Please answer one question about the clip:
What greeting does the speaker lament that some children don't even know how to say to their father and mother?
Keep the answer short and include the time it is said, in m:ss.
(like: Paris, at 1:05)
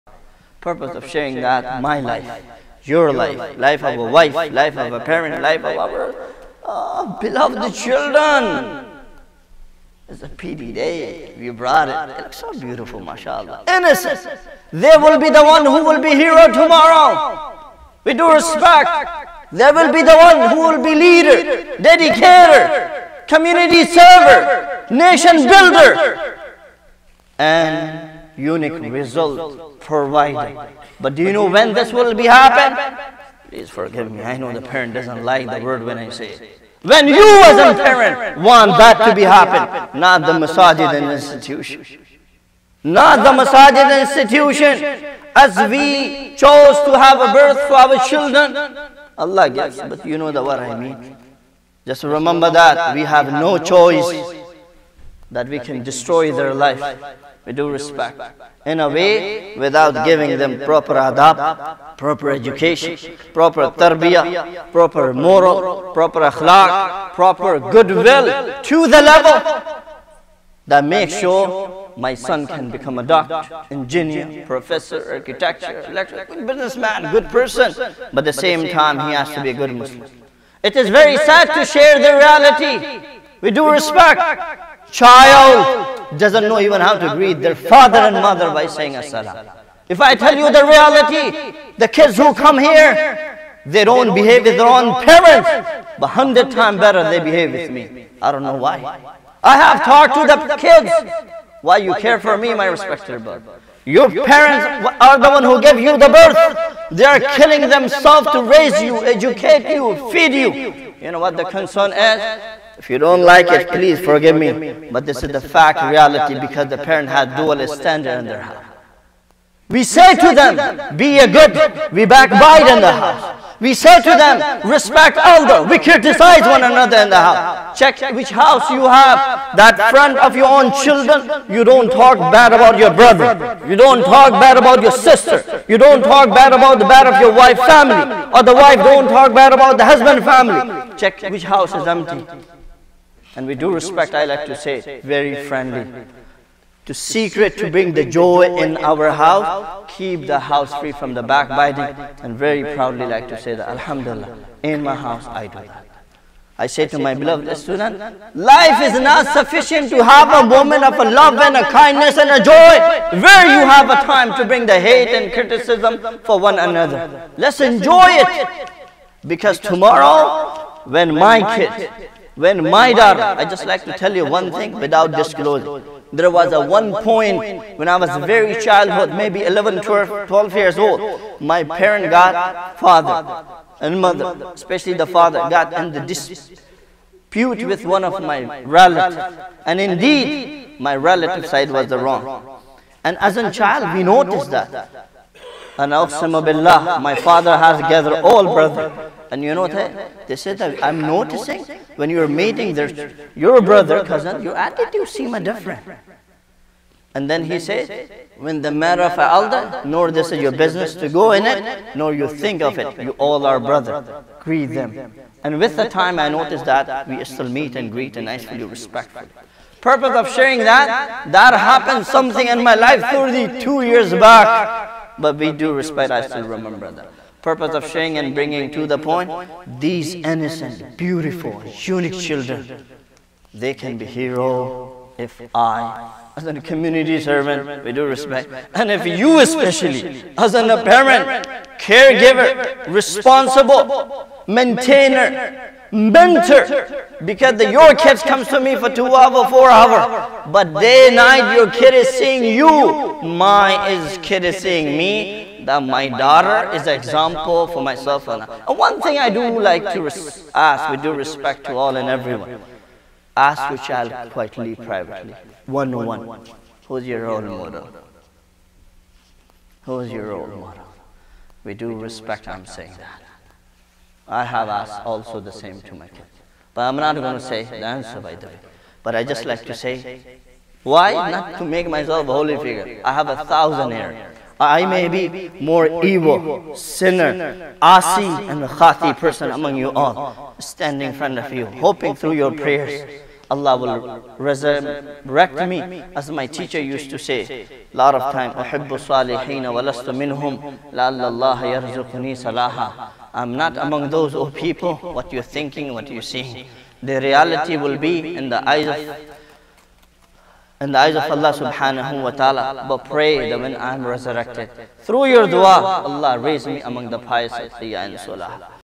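Assalam, at 1:28.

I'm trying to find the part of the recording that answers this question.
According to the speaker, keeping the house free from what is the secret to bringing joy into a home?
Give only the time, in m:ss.
2:31.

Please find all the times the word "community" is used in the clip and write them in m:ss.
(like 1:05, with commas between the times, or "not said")
0:23, 3:56.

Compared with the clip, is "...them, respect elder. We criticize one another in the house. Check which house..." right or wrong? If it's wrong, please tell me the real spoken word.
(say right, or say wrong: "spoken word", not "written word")
right.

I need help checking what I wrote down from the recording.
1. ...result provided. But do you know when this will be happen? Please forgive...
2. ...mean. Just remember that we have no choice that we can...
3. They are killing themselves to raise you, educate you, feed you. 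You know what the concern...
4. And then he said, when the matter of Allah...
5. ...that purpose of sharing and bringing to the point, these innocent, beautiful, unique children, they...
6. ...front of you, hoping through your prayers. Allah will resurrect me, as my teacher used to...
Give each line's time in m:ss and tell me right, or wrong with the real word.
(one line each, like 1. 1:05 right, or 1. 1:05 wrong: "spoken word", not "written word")
1. 0:28 right
2. 0:50 right
3. 1:46 right
4. 3:27 wrong: "Alda", not "Allah"
5. 3:46 right
6. 4:51 right.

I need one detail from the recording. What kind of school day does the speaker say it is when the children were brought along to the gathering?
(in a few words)
PD day.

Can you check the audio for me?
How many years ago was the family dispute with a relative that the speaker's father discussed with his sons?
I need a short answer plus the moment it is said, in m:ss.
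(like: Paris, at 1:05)
32, at 3:43.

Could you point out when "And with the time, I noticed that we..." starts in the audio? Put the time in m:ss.
3:35.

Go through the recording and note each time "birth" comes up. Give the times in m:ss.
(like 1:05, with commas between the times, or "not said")
0:47, 1:46.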